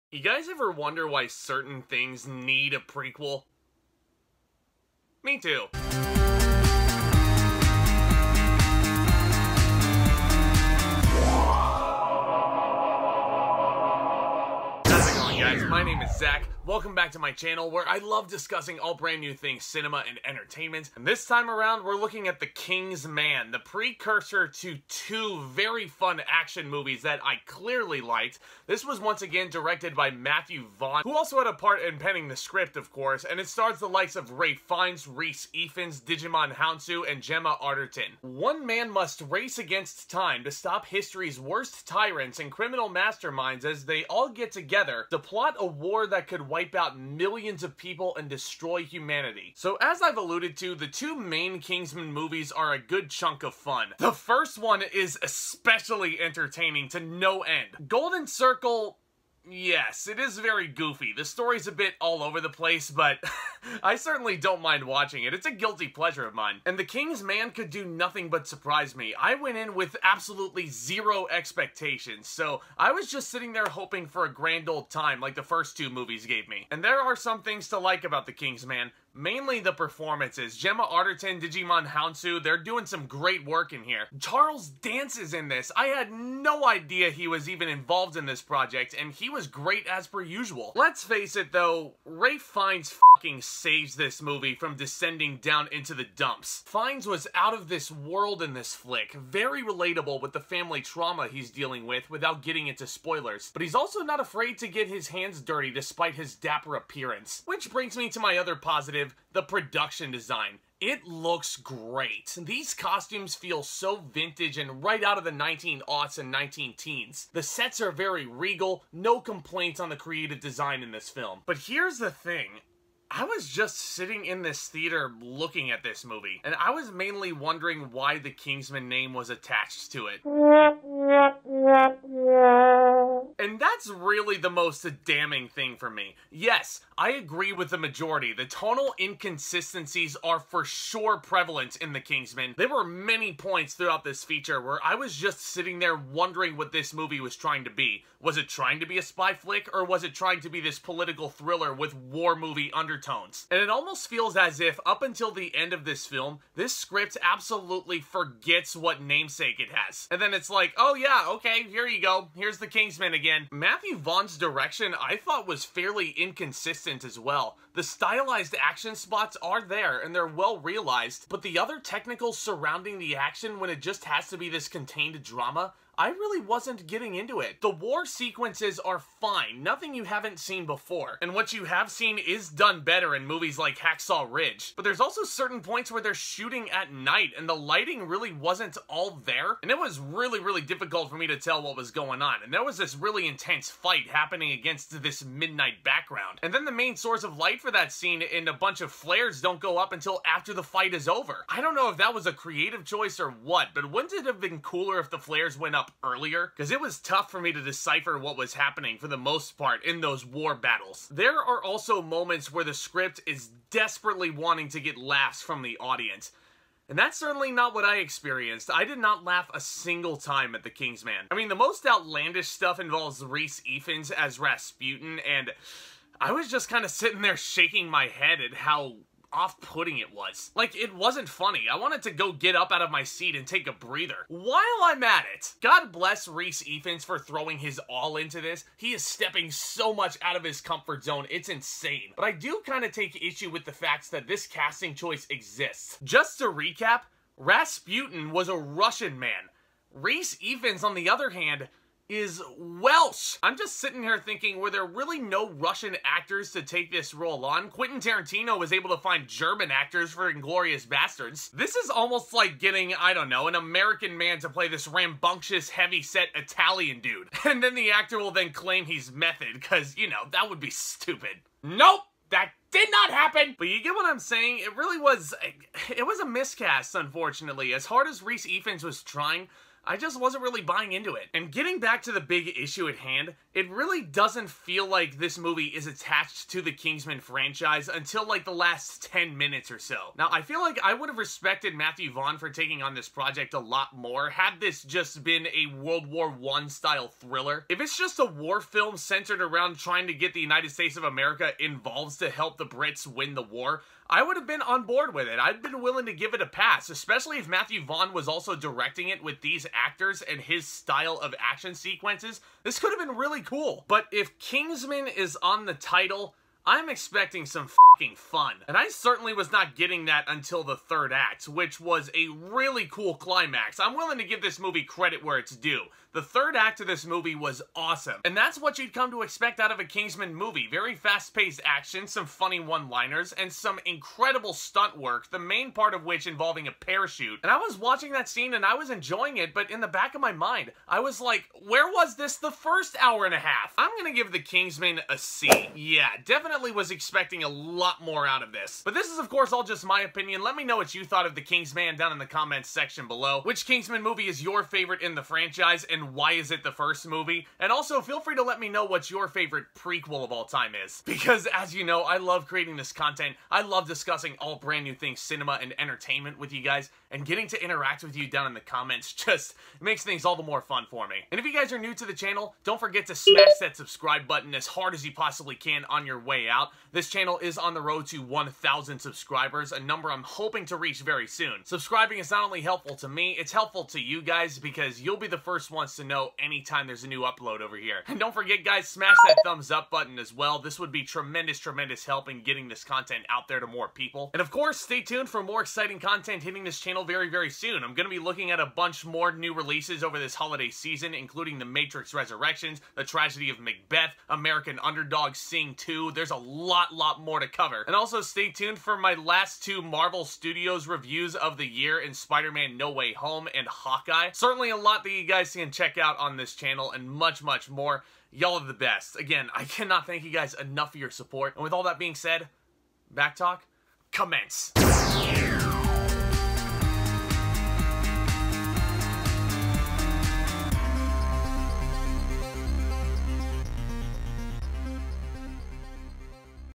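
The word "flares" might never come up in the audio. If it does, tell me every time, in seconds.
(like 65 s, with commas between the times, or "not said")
198 s, 205 s.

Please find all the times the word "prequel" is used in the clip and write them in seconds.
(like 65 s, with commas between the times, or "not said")
2 s, 359 s.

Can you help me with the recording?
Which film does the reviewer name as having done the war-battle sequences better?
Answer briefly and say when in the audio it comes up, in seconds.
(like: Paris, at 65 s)
Hacksaw Ridge, at 183 s.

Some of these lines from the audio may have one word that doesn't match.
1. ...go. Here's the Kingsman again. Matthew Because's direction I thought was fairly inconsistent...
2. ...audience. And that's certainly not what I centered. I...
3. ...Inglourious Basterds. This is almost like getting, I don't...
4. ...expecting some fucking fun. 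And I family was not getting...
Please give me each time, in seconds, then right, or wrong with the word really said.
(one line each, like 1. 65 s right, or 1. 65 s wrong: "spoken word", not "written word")
1. 162 s wrong: "Vaughn", not "Because"
2. 215 s wrong: "experienced", not "centered"
3. 260 s right
4. 316 s wrong: "certainly", not "family".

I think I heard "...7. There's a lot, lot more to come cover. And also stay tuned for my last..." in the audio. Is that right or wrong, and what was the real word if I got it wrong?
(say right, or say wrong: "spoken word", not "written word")
wrong: "2", not "7".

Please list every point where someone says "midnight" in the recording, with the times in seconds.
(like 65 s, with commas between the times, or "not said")
195 s.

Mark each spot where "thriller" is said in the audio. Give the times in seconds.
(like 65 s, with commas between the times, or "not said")
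151 s, 297 s.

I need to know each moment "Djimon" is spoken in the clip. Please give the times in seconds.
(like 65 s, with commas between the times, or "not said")
36 s, 81 s.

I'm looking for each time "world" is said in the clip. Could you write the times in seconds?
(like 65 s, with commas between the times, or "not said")
97 s, 295 s.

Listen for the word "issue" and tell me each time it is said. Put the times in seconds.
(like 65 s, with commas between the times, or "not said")
243 s, 282 s.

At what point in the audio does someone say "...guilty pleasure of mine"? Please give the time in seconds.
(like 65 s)
65 s.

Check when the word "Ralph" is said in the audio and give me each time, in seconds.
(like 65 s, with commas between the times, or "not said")
34 s, 92 s.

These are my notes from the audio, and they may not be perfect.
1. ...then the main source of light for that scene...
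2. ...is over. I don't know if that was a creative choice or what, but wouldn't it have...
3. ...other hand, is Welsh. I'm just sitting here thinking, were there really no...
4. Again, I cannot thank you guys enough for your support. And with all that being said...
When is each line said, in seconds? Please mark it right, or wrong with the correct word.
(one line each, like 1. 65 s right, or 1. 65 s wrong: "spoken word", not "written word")
1. 196 s right
2. 200 s right
3. 251 s right
4. 419 s right.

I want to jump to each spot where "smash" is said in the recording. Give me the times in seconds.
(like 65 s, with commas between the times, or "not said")
373 s, 388 s.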